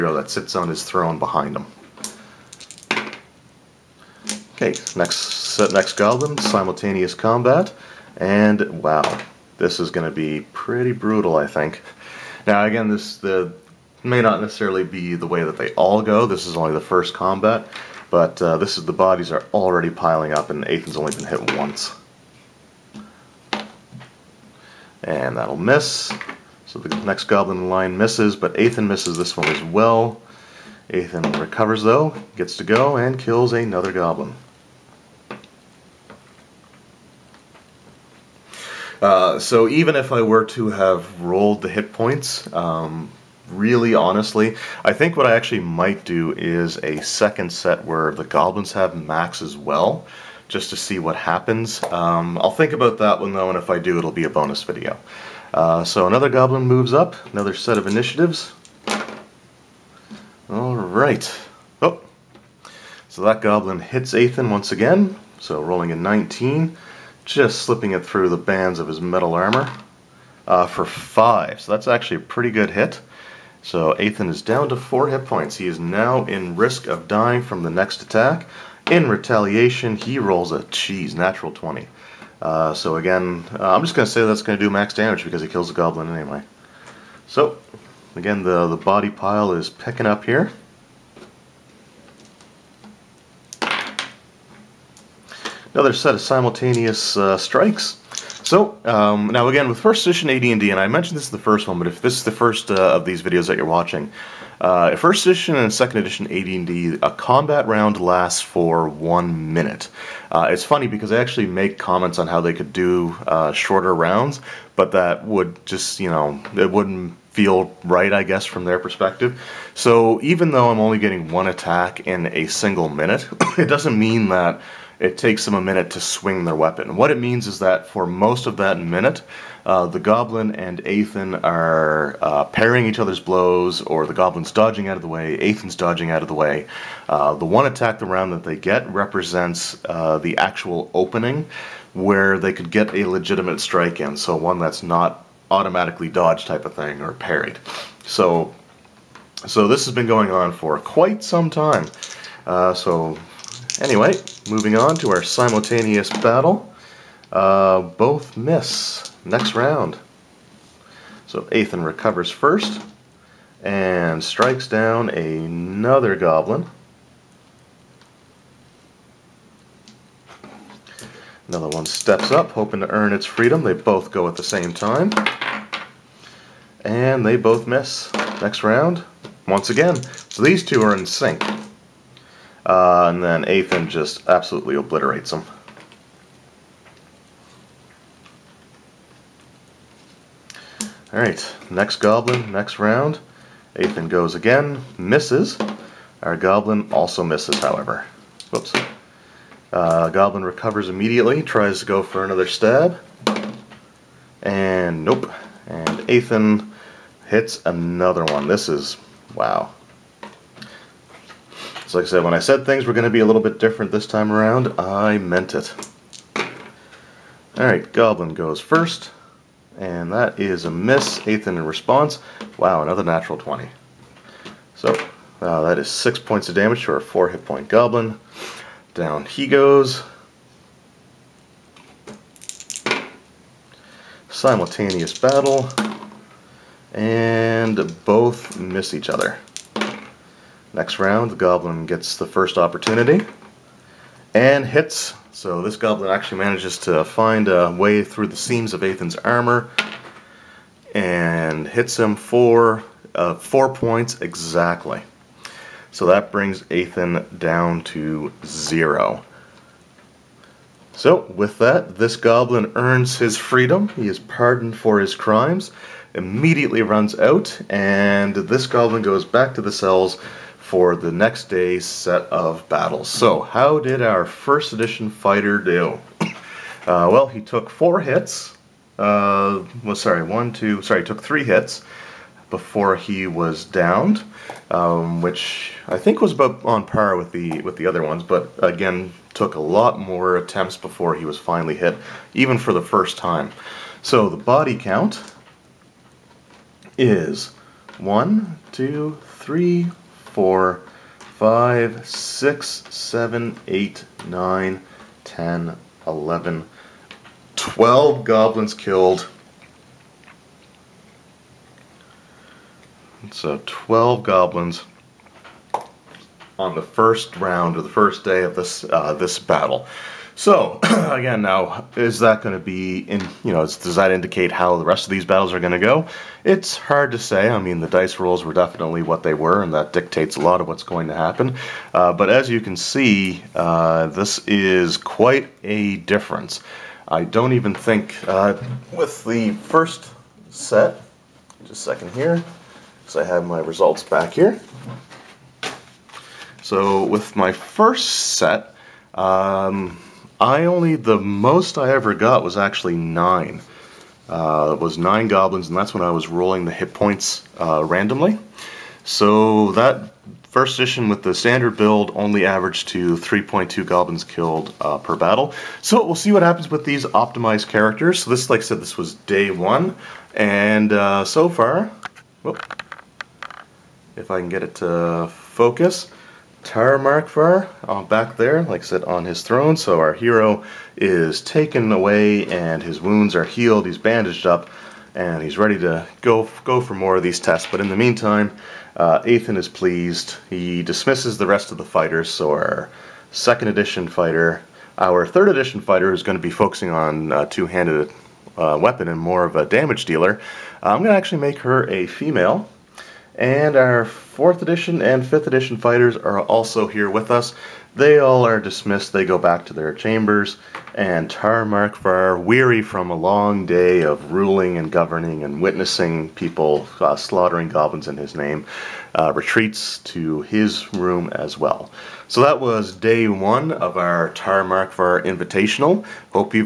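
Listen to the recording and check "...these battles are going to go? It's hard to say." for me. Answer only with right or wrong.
right.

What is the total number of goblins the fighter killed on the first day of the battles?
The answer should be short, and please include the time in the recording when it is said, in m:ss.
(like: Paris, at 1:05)
12, at 5:07.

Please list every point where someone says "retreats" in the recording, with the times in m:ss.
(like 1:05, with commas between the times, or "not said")
6:59.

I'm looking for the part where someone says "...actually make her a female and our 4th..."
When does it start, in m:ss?
6:41.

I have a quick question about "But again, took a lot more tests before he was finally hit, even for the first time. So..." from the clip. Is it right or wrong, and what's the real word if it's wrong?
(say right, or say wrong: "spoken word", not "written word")
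wrong: "attempts", not "tests".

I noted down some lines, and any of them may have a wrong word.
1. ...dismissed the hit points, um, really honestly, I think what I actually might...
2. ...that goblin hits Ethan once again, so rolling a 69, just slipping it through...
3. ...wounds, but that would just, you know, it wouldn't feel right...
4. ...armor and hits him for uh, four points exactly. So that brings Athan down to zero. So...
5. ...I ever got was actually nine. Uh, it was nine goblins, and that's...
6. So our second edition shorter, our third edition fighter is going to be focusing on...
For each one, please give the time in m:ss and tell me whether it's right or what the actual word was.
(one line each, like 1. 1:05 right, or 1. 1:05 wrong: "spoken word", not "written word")
1. 0:41 wrong: "rolled", not "dismissed"
2. 1:03 wrong: "19", not "69"
3. 1:53 wrong: "rounds", not "wounds"
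4. 4:09 right
5. 5:51 right
6. 6:32 wrong: "fighter", not "shorter".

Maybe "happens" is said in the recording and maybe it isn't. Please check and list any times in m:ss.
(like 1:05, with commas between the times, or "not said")
0:51, 5:31, 6:06.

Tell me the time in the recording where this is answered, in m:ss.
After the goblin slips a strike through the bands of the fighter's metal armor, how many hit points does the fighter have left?
1:13.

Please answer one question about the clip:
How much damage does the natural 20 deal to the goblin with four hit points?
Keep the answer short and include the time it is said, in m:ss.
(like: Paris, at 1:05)
6, at 3:45.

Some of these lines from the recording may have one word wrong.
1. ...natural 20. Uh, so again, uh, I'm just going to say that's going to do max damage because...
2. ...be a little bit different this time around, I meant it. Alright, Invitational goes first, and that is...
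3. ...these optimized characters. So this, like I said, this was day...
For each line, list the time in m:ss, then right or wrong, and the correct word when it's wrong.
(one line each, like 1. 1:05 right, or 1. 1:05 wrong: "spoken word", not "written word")
1. 1:21 right
2. 3:33 wrong: "Goblin", not "Invitational"
3. 6:06 right.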